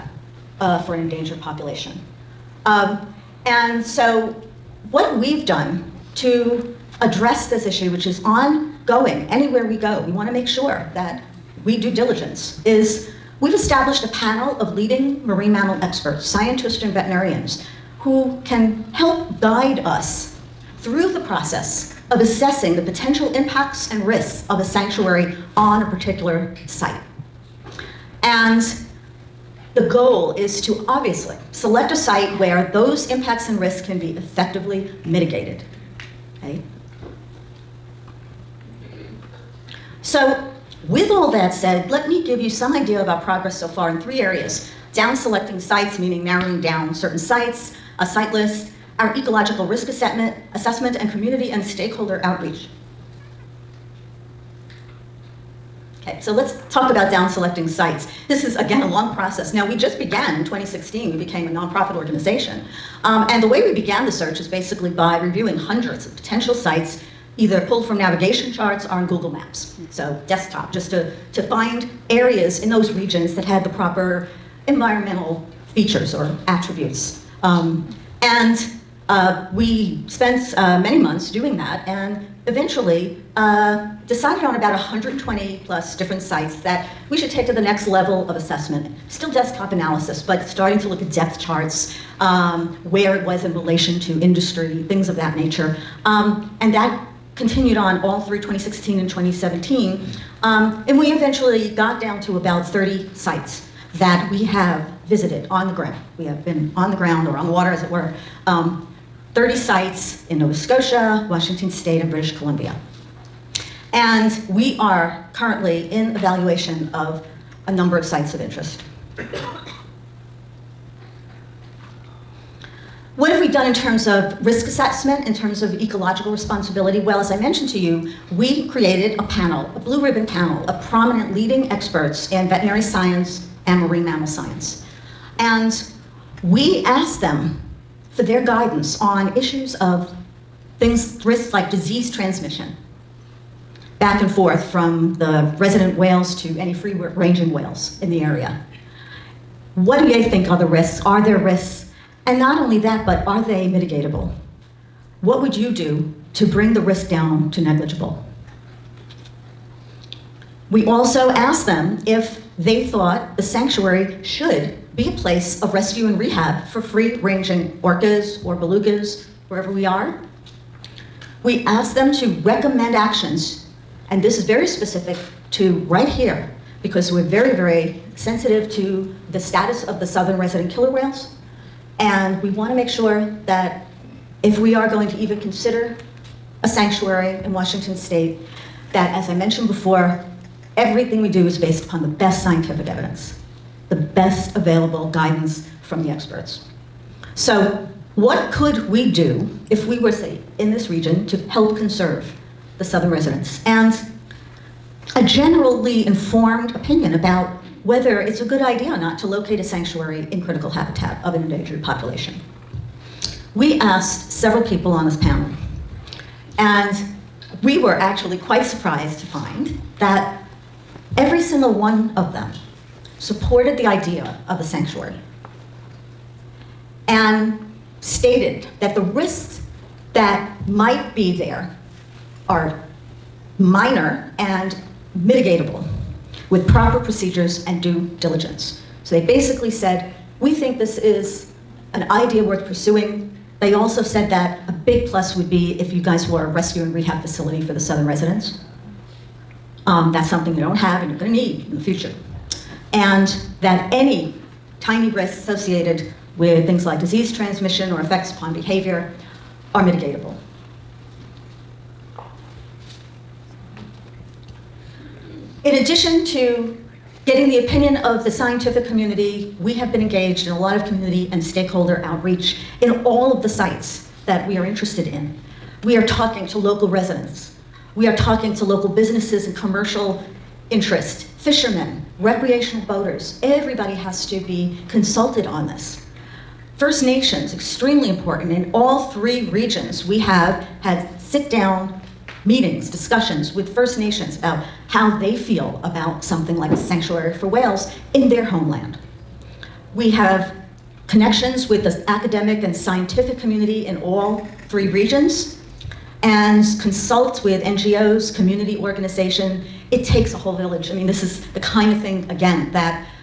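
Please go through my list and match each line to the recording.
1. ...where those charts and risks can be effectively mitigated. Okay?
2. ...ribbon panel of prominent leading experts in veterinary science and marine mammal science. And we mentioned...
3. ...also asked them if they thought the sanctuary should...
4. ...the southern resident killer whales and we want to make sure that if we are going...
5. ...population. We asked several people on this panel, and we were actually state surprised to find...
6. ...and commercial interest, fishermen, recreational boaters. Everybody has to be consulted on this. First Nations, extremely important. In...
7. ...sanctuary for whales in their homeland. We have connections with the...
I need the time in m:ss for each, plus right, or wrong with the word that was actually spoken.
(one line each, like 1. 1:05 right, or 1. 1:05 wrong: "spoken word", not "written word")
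1. 0:32 wrong: "impacts", not "charts"
2. 2:10 wrong: "asked", not "mentioned"
3. 2:40 right
4. 2:59 right
5. 3:31 wrong: "quite", not "state"
6. 4:39 right
7. 4:56 right.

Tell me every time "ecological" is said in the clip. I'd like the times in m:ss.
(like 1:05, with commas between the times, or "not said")
0:49, 2:05.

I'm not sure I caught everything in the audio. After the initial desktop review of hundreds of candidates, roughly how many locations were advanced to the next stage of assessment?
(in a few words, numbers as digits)
120.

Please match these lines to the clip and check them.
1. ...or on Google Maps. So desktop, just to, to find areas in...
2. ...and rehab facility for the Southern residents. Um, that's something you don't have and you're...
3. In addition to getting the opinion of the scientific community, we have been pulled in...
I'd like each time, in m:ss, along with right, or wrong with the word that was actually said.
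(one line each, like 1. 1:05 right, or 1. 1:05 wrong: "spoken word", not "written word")
1. 1:08 right
2. 4:06 right
3. 4:25 wrong: "engaged", not "pulled".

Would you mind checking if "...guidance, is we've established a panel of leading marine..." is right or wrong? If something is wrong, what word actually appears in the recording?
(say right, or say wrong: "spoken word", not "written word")
wrong: "diligence", not "guidance".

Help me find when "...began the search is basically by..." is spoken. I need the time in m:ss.
1:03.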